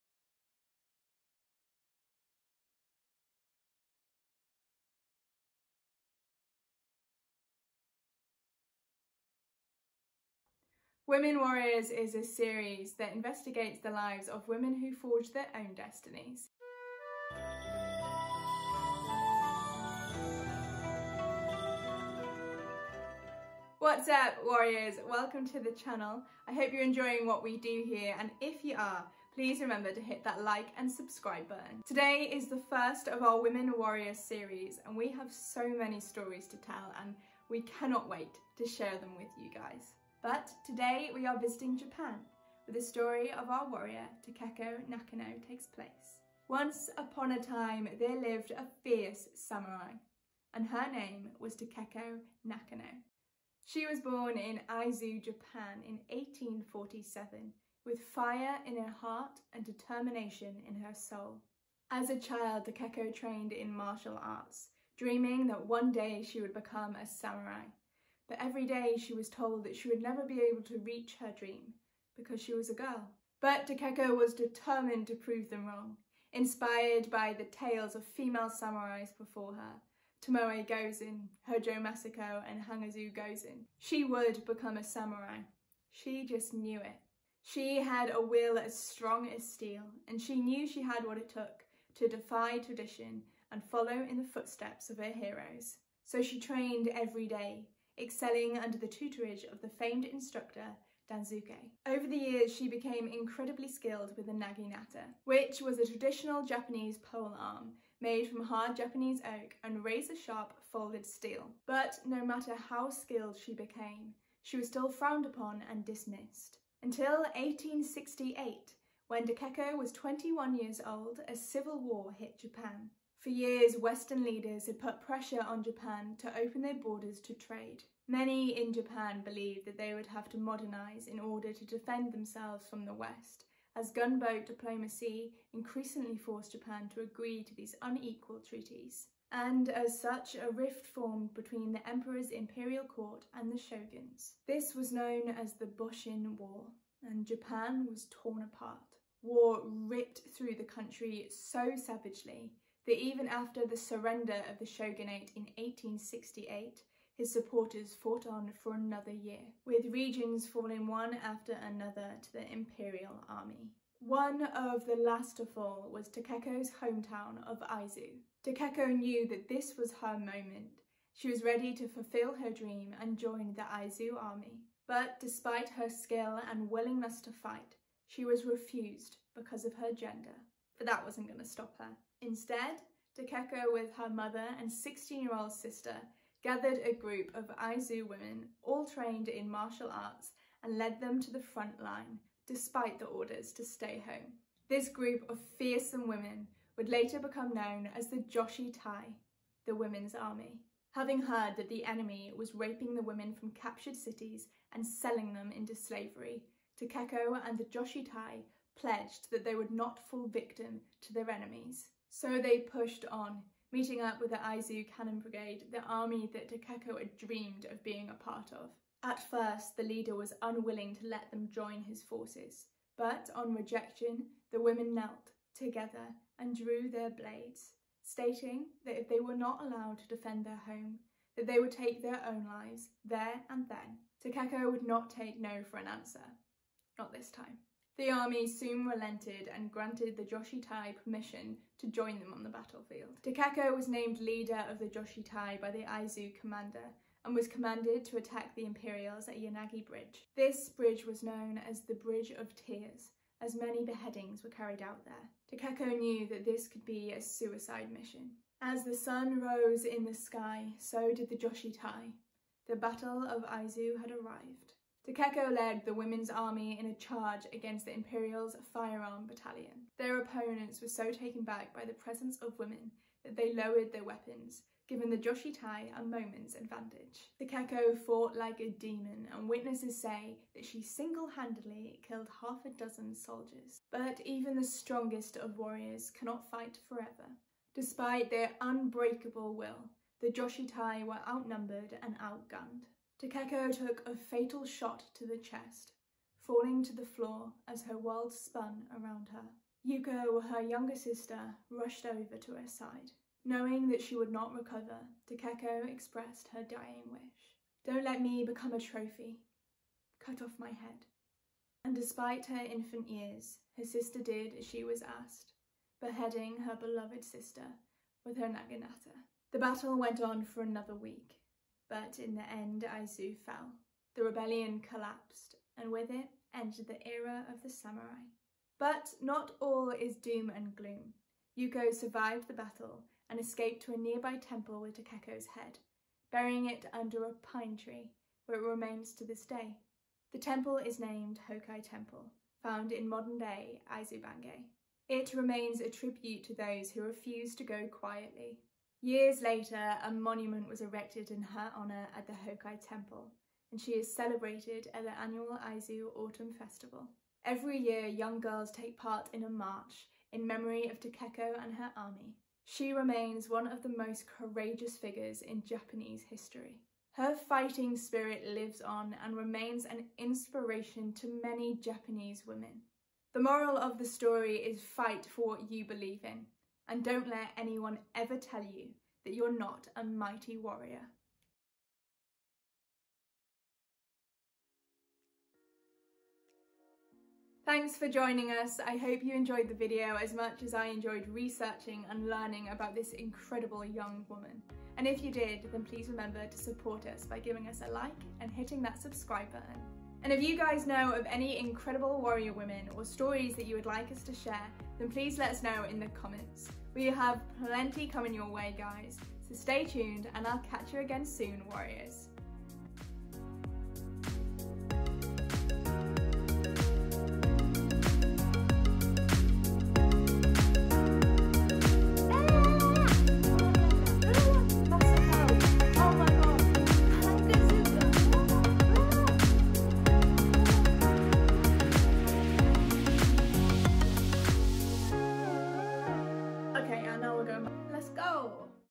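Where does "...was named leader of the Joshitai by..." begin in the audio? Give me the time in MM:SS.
04:03.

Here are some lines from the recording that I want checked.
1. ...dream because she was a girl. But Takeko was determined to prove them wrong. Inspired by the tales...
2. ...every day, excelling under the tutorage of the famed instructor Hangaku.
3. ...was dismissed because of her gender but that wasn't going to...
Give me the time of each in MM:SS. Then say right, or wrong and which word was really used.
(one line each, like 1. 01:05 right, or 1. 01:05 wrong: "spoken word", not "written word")
1. 01:11 right
2. 01:36 wrong: "Daisuke", not "Hangaku"
3. 02:58 wrong: "refused", not "dismissed".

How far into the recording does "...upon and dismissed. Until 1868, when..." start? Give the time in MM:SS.
01:55.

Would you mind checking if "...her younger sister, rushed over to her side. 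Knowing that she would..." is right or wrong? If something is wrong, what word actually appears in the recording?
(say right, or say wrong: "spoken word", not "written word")
right.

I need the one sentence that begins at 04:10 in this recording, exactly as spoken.
This bridge was known as the Bridge of Tears, as many beheadings were carried out there.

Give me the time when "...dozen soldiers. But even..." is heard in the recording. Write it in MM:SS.
04:42.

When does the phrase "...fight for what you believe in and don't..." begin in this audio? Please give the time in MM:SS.
06:14.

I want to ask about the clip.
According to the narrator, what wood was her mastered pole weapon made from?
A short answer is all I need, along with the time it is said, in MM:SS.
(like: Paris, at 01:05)
Hard Japanese oak, at 01:48.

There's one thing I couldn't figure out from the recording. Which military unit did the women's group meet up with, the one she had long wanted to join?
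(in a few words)
Aizu Cannon Brigade.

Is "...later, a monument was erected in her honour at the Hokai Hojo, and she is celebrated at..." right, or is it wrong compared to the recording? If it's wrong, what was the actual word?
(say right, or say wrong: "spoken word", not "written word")
wrong: "Temple", not "Hojo".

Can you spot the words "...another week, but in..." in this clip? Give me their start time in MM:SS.
05:20.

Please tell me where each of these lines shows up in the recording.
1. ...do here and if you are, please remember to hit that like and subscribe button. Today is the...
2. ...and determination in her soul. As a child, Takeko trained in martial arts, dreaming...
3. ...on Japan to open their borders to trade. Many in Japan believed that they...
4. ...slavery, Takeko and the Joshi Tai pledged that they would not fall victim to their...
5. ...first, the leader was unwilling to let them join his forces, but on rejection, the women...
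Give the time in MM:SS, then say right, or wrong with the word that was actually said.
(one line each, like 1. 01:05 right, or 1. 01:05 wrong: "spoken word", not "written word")
1. 00:27 right
2. 00:59 right
3. 02:05 right
4. 03:25 right
5. 03:39 right.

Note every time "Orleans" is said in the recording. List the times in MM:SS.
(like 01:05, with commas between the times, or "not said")
not said.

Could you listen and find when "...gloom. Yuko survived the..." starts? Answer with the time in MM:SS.
05:30.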